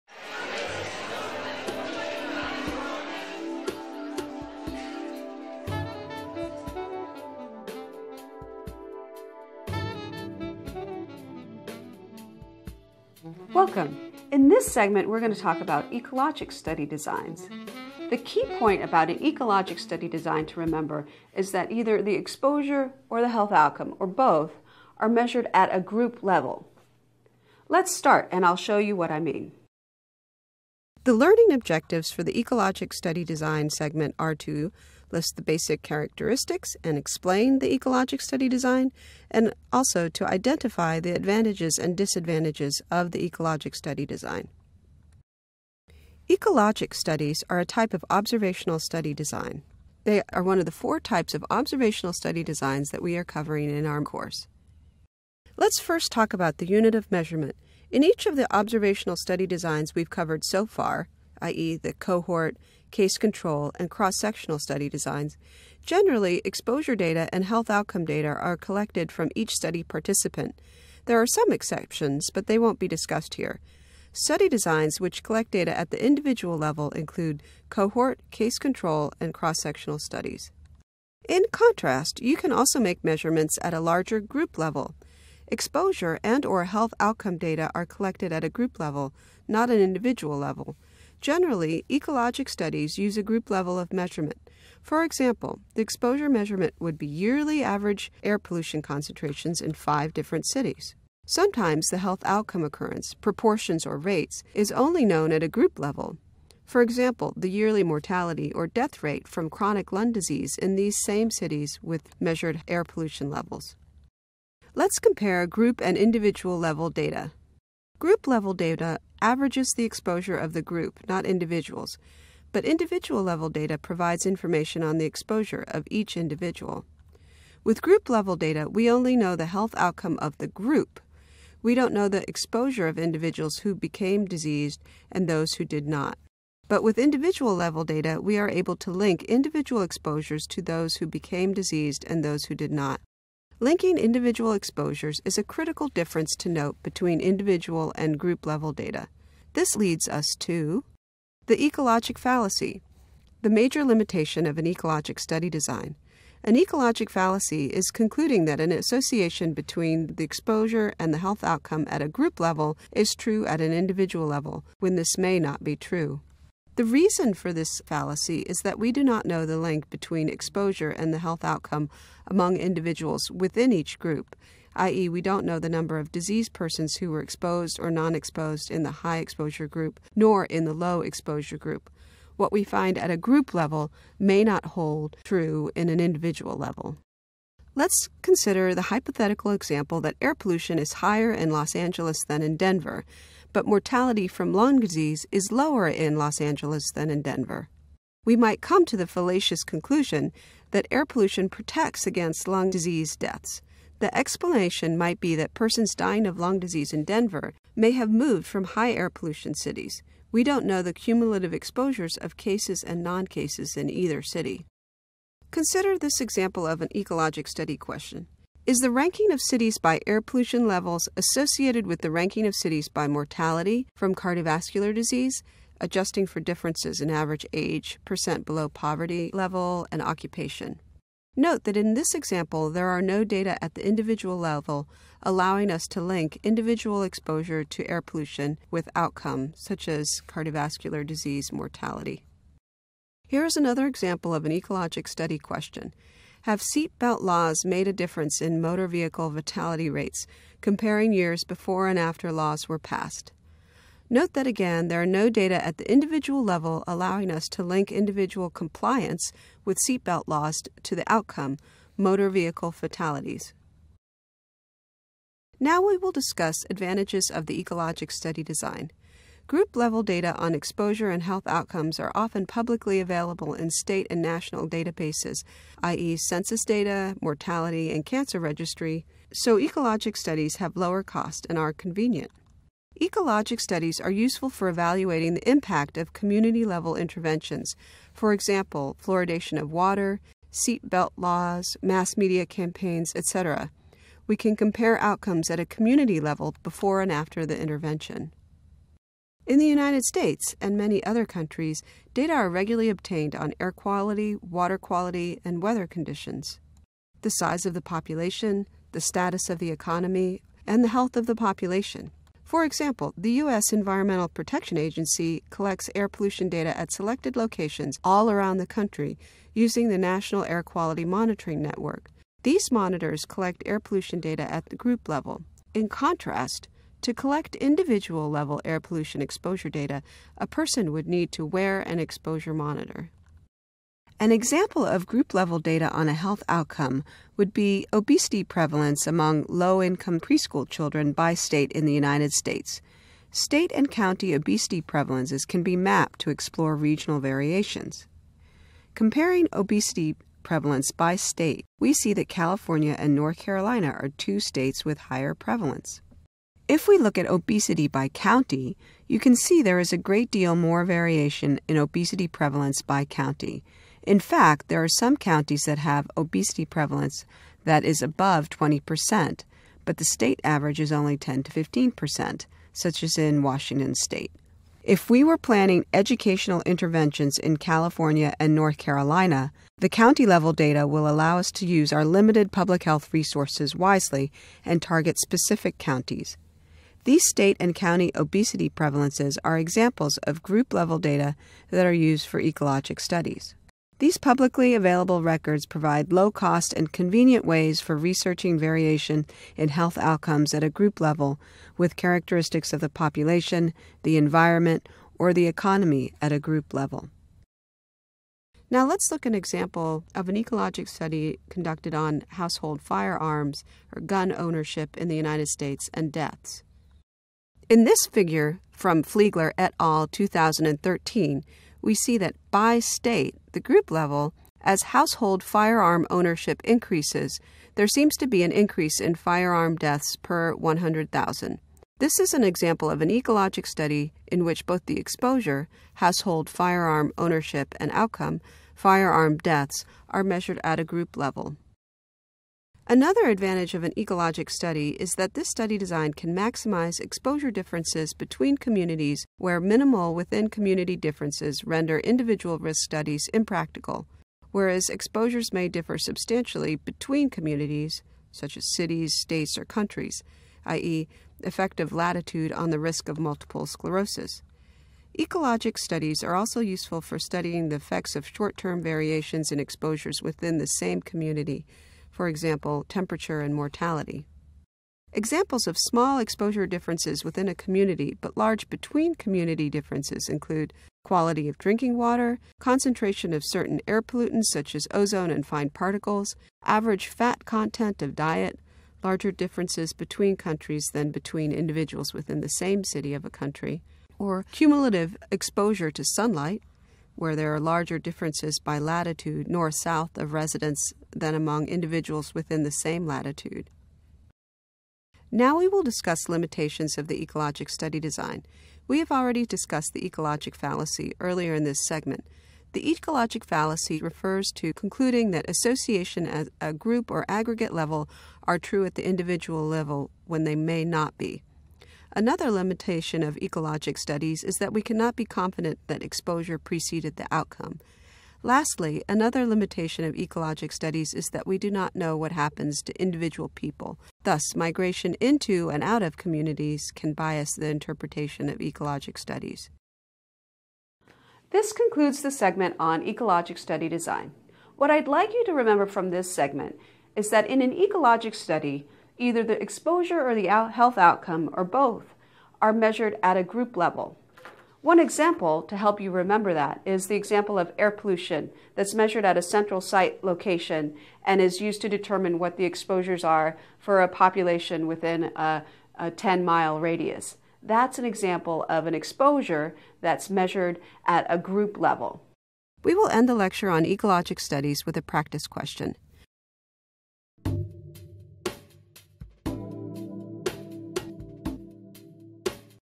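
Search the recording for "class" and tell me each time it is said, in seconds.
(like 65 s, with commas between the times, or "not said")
not said.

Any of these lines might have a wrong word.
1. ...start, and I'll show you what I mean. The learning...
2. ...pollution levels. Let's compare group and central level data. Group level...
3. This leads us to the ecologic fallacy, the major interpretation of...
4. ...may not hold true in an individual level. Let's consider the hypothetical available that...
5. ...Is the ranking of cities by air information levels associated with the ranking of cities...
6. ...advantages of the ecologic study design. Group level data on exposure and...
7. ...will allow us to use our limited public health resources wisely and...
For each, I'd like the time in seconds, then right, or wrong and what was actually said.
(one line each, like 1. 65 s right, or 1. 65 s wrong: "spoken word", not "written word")
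1. 27 s right
2. 112 s wrong: "individual", not "central"
3. 149 s wrong: "limitation", not "interpretation"
4. 184 s wrong: "example", not "available"
5. 218 s wrong: "pollution", not "information"
6. 266 s right
7. 380 s right.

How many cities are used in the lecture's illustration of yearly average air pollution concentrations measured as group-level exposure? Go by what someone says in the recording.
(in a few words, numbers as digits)
5.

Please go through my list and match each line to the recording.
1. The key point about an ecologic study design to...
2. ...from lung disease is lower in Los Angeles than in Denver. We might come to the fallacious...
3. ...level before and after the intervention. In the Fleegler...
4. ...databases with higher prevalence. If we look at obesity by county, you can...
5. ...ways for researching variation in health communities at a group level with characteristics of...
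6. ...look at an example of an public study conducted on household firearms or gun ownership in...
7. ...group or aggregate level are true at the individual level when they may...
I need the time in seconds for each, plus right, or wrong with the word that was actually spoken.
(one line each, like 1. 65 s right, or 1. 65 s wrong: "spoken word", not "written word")
1. 18 s right
2. 194 s right
3. 296 s wrong: "United", not "Fleegler"
4. 354 s wrong: "states", not "databases"
5. 397 s wrong: "outcomes", not "communities"
6. 409 s wrong: "ecologic", not "public"
7. 516 s right.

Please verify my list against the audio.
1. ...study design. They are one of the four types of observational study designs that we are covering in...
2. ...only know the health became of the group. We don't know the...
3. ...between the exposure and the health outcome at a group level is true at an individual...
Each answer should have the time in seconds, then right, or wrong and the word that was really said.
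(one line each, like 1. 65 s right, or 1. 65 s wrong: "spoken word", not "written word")
1. 48 s right
2. 128 s wrong: "outcome", not "became"
3. 159 s right.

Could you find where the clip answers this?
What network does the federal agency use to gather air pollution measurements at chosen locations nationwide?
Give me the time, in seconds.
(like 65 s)
319 s.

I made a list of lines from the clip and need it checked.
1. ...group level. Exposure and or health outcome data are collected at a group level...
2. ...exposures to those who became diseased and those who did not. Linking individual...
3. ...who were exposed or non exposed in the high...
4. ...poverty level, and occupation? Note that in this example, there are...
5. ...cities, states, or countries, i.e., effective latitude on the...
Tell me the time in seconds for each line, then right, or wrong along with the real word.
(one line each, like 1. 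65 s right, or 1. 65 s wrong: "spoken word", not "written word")
1. 84 s right
2. 139 s right
3. 176 s right
4. 228 s right
5. 458 s right.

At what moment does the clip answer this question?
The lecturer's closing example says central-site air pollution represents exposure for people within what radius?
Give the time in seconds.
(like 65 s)
566 s.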